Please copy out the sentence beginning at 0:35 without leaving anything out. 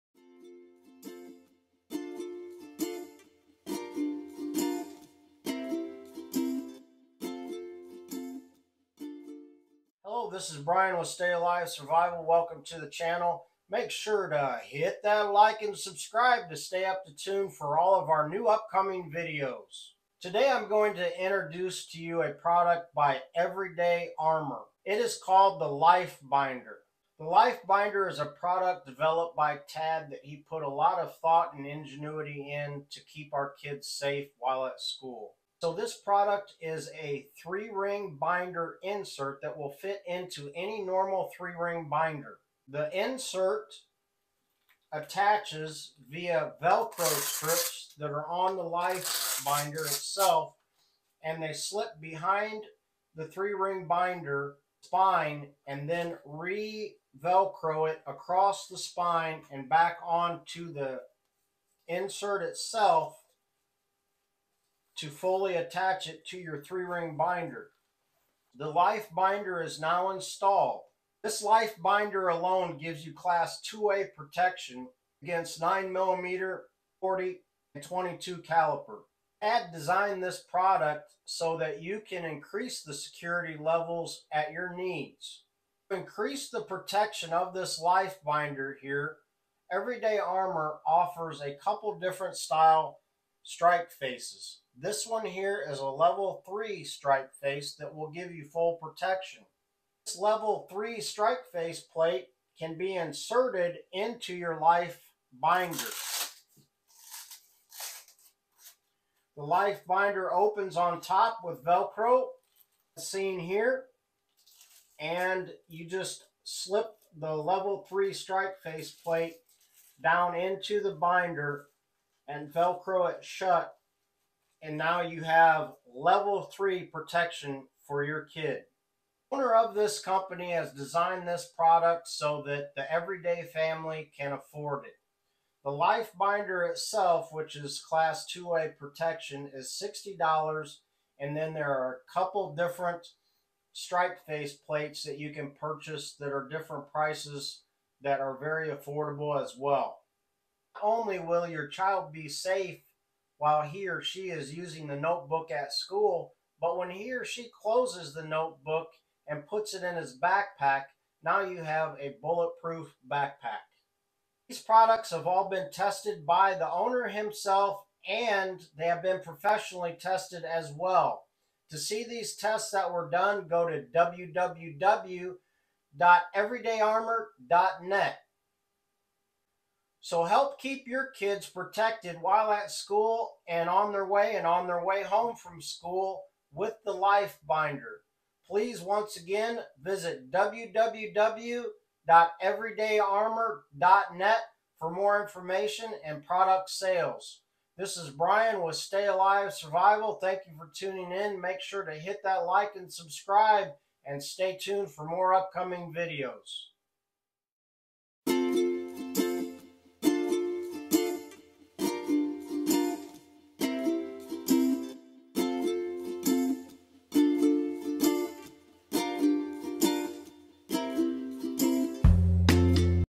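So this product is a three ring binder insert that will fit into any normal three ring binder.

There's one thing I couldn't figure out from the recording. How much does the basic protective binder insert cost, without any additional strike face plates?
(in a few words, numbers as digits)
$60.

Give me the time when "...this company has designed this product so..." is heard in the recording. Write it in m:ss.
2:09.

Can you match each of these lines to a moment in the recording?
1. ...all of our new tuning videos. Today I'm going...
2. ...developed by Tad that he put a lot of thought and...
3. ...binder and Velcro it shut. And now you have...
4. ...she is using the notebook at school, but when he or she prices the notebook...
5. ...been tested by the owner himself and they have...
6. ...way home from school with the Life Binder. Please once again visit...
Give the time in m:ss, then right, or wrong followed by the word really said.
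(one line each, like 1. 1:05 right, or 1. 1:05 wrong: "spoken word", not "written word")
1. 0:17 wrong: "upcoming", not "tuning"
2. 0:28 right
3. 2:00 right
4. 2:34 wrong: "closes", not "prices"
5. 2:45 right
6. 3:04 right.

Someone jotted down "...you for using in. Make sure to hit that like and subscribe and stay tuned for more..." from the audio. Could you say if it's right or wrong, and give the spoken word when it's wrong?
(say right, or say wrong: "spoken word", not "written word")
wrong: "tuning", not "using".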